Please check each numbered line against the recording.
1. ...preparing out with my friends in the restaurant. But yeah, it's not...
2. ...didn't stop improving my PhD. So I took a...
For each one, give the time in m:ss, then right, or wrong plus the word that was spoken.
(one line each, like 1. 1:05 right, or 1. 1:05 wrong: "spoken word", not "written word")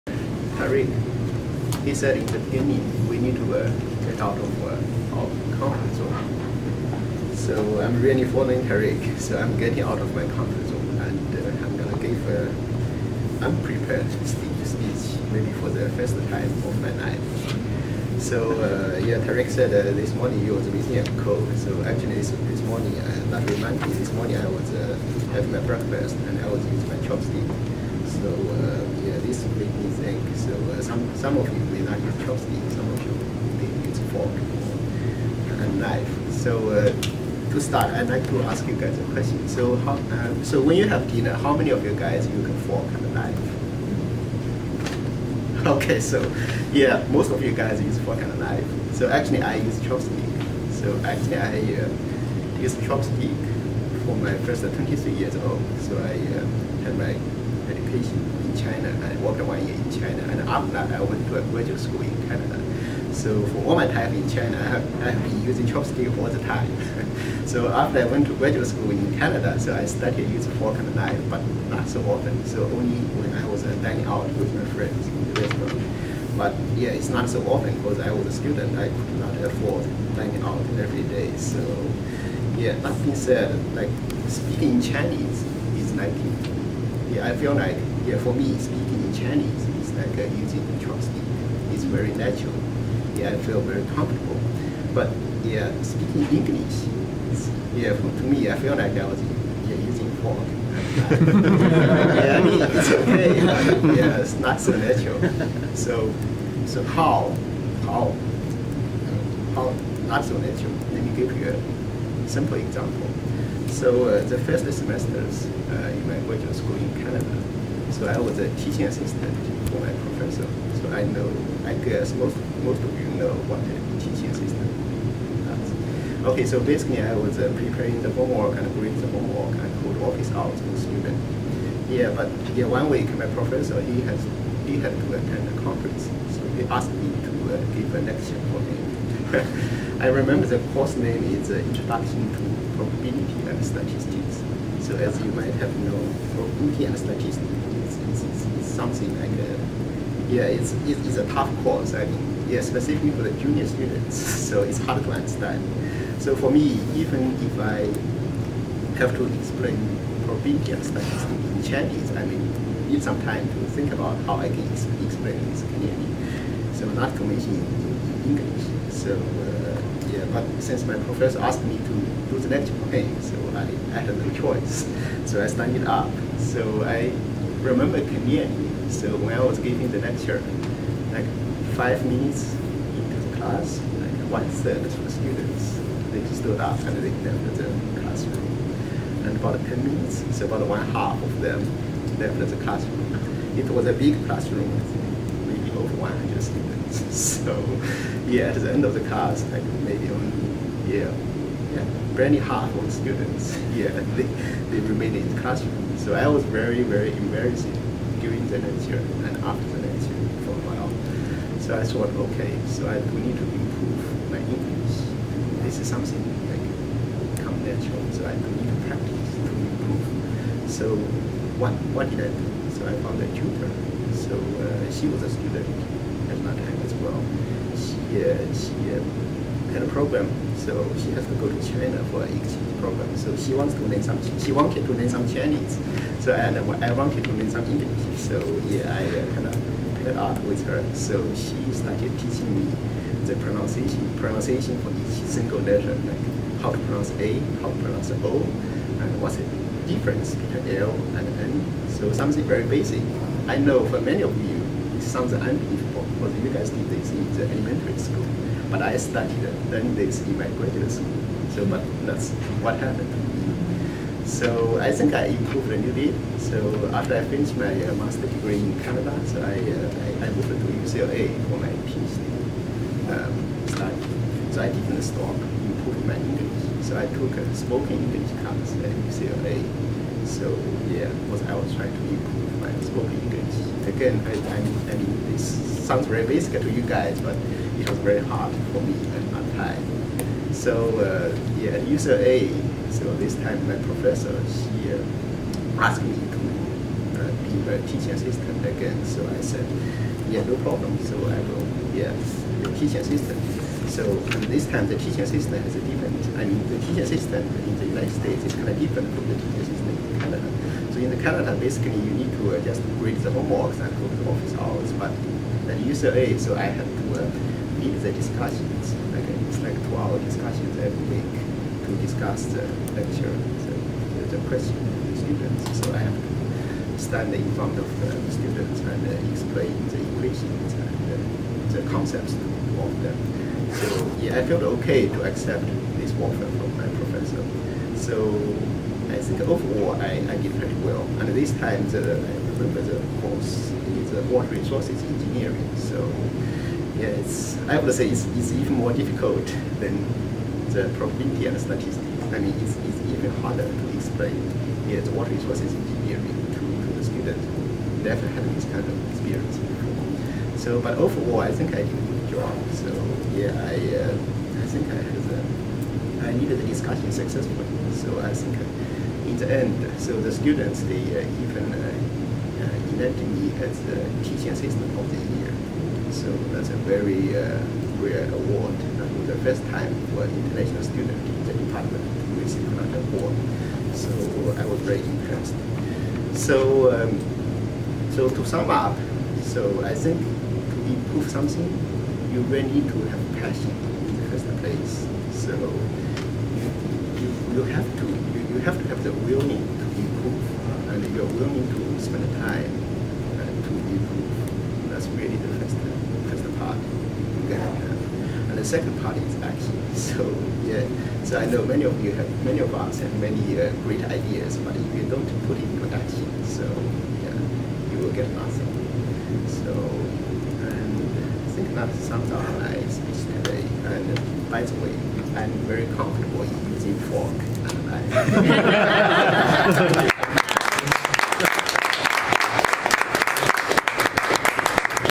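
1. 1:13 wrong: "dining", not "preparing"
2. 4:34 wrong: "English", not "PhD".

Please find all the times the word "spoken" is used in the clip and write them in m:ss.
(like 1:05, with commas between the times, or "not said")
4:37, 4:42.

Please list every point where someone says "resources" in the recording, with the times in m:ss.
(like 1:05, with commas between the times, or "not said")
5:44, 5:55.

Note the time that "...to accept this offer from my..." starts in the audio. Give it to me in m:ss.
5:35.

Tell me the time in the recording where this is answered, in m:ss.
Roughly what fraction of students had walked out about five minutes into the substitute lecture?
3:04.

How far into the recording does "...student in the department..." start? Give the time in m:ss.
6:20.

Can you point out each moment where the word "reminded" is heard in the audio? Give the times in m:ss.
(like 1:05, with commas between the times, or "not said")
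0:23.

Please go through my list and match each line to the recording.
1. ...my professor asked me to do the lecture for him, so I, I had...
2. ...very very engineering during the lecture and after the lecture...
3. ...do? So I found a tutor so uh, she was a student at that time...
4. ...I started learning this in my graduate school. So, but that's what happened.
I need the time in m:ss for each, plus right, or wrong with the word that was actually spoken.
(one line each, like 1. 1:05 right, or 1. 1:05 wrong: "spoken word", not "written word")
1. 2:50 right
2. 3:26 wrong: "embarrassing", not "engineering"
3. 3:42 right
4. 4:18 right.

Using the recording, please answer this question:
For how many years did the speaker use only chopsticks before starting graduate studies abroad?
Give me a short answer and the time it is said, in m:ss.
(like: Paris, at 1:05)
23, at 0:54.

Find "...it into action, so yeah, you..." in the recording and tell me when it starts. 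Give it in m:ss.
6:55.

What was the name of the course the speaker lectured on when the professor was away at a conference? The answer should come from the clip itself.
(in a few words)
Introduction to Probability and Statistics.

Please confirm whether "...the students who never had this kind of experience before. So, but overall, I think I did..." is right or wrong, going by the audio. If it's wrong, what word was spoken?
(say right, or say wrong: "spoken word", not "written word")
right.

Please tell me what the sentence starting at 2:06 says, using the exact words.
Okay, so basically I was uh, preparing the homework and grading the homework and could office out to the student.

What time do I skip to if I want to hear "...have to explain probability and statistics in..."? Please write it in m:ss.
2:38.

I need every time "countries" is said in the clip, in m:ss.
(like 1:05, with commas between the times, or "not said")
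not said.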